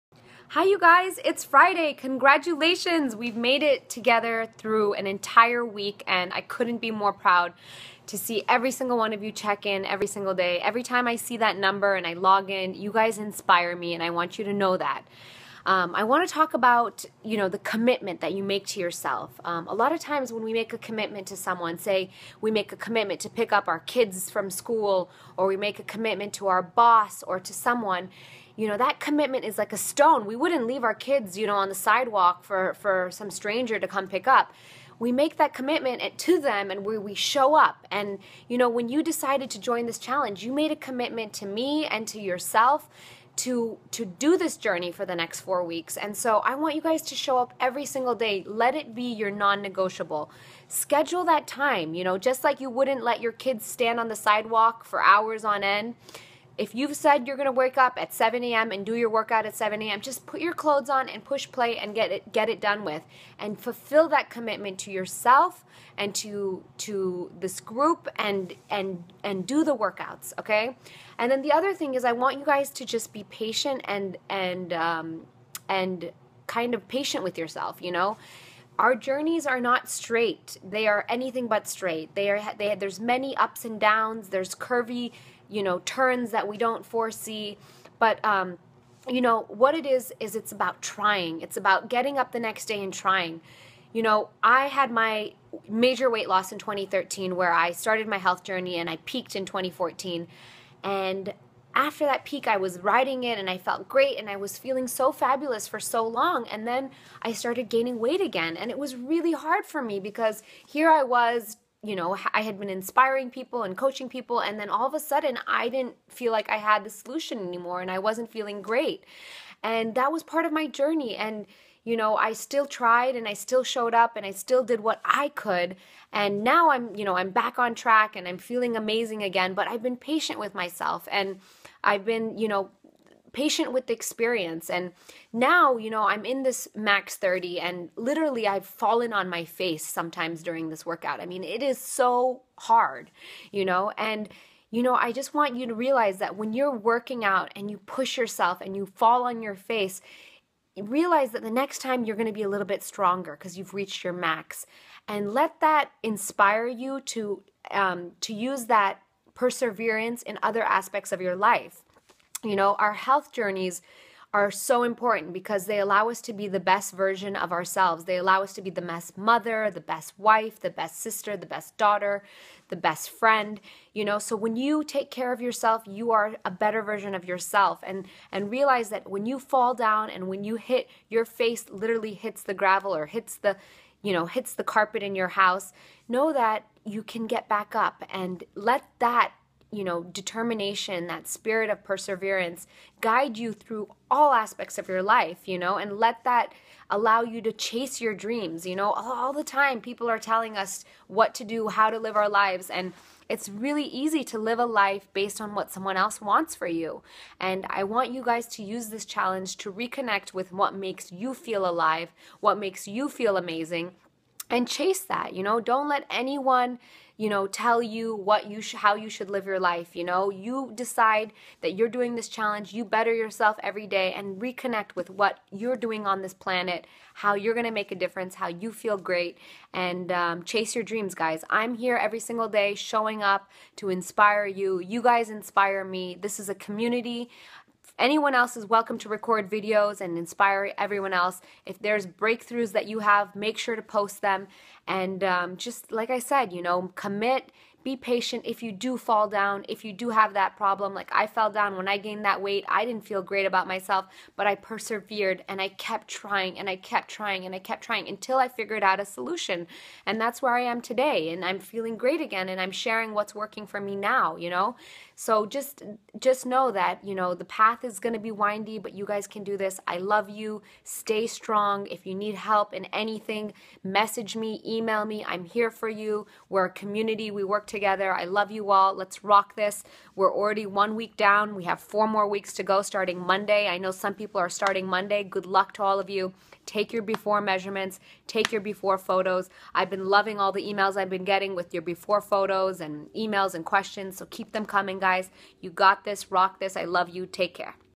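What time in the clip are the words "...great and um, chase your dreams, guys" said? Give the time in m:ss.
3:48.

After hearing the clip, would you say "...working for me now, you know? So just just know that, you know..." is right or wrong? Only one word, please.
right.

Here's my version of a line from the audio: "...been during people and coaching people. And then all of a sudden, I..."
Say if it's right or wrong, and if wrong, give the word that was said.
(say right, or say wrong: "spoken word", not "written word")
wrong: "inspiring", not "during".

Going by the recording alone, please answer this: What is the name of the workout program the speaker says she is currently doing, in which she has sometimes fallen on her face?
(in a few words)
Max 30.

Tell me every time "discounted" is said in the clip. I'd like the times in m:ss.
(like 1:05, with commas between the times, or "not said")
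not said.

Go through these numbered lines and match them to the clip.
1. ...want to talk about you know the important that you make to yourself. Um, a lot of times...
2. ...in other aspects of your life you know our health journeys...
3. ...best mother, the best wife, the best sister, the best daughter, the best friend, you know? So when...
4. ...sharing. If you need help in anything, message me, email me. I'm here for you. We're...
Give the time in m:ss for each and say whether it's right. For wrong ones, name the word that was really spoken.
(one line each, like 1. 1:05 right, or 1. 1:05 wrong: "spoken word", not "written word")
1. 0:16 wrong: "commitment", not "important"
2. 2:40 right
3. 2:48 right
4. 4:31 wrong: "strong", not "sharing".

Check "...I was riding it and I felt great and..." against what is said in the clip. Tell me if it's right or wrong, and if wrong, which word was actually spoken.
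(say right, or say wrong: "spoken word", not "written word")
right.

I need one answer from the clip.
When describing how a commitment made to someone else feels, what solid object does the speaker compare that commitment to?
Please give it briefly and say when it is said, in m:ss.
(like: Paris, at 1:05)
A stone, at 0:29.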